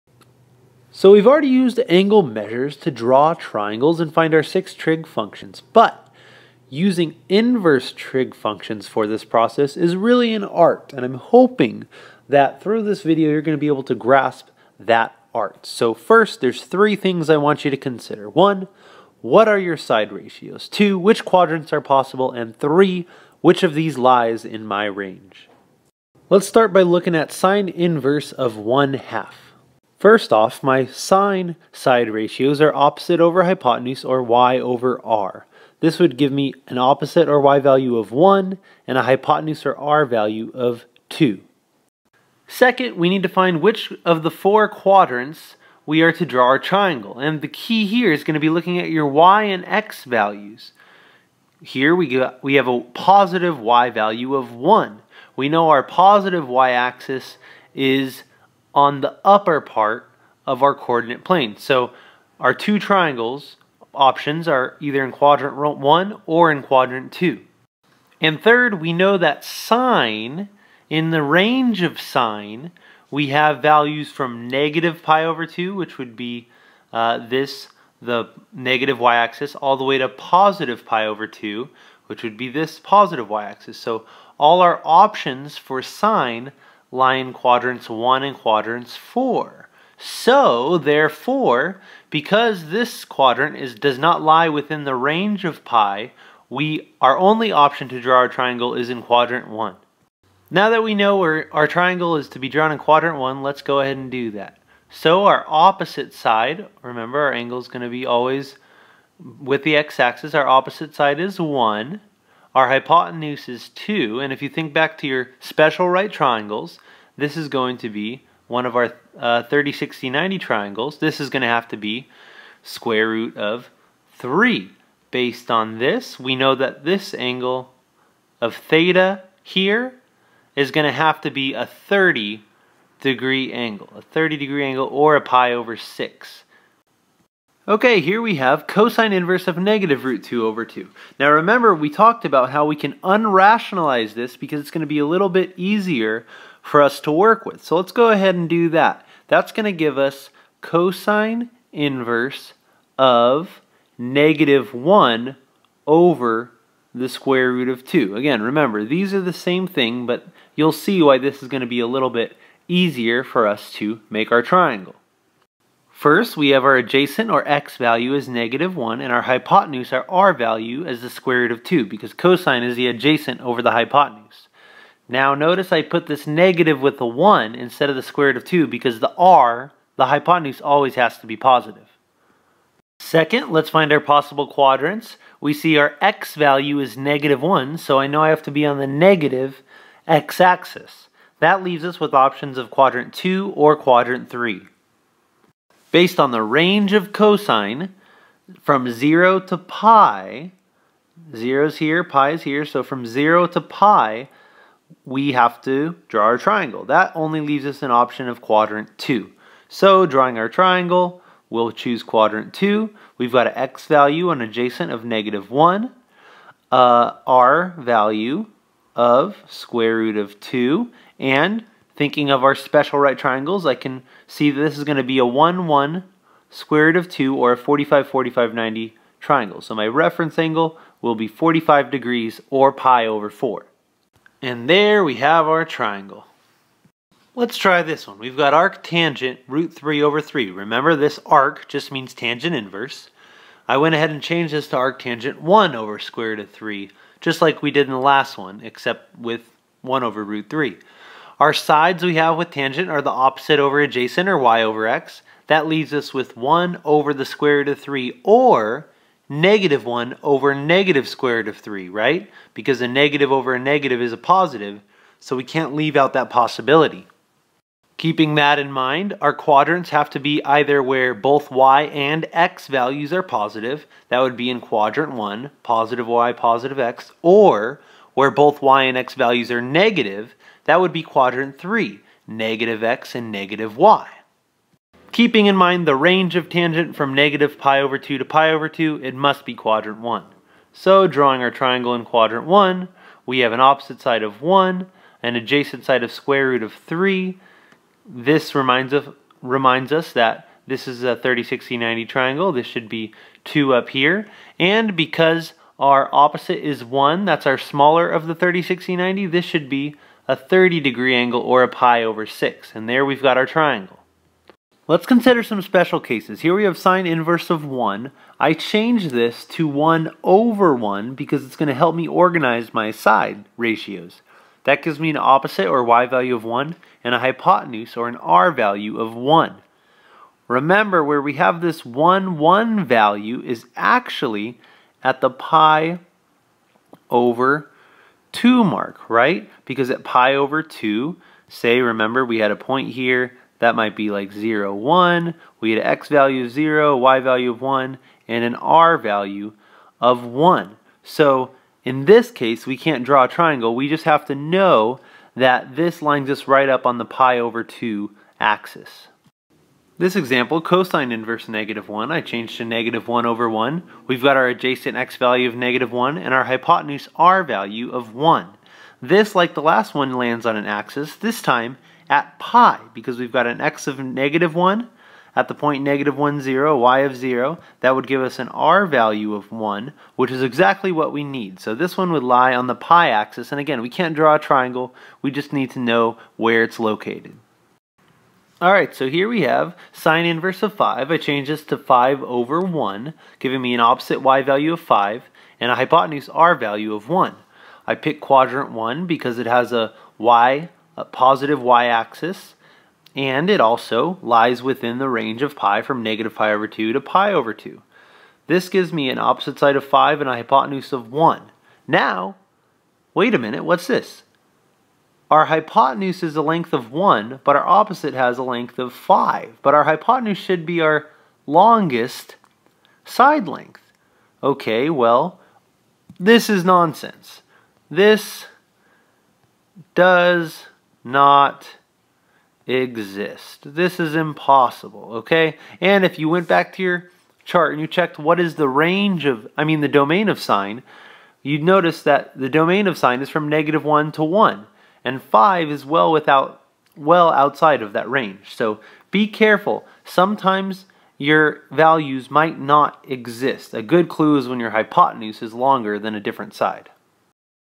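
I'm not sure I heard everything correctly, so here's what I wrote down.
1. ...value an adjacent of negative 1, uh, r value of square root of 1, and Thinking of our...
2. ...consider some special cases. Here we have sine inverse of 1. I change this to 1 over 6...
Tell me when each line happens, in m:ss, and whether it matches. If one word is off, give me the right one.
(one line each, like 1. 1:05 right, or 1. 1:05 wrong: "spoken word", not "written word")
1. 3:33 wrong: "2", not "1"
2. 5:15 wrong: "1", not "6".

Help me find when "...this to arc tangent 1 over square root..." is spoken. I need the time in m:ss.
4:04.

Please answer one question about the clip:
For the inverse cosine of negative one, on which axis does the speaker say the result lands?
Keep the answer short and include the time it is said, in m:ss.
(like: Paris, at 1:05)
the pi axis, at 6:22.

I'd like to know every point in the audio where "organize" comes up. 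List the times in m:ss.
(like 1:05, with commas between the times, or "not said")
5:22.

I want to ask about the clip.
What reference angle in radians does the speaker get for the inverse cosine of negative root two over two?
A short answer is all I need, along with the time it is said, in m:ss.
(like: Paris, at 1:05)
pi over 4, at 3:52.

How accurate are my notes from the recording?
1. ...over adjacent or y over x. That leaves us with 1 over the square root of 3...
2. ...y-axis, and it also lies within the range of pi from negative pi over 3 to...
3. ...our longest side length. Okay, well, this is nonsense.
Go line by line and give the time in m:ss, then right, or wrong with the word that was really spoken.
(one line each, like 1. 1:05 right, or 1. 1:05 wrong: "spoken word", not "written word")
1. 4:13 right
2. 6:41 wrong: "2", not "3"
3. 7:00 right.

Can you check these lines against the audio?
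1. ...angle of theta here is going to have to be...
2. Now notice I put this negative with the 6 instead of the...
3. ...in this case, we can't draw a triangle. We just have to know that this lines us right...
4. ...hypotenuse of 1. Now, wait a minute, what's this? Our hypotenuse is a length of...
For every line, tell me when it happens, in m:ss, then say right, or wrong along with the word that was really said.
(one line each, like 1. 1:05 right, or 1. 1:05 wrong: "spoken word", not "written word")
1. 2:07 right
2. 2:55 wrong: "1", not "6"
3. 5:51 right
4. 6:50 right.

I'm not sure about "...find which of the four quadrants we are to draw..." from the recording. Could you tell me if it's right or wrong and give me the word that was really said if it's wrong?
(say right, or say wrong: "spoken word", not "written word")
right.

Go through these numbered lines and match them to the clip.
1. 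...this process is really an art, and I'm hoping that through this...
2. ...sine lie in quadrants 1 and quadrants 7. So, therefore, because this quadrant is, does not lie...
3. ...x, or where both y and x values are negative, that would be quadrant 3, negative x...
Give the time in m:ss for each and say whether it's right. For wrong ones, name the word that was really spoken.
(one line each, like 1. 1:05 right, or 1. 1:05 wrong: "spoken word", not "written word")
1. 0:09 right
2. 1:25 wrong: "4", not "7"
3. 4:36 right.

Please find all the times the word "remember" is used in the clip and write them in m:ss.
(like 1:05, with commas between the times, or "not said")
1:46, 2:21, 2:38, 4:00, 5:30, 5:41.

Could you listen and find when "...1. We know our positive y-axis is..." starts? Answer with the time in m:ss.
0:54.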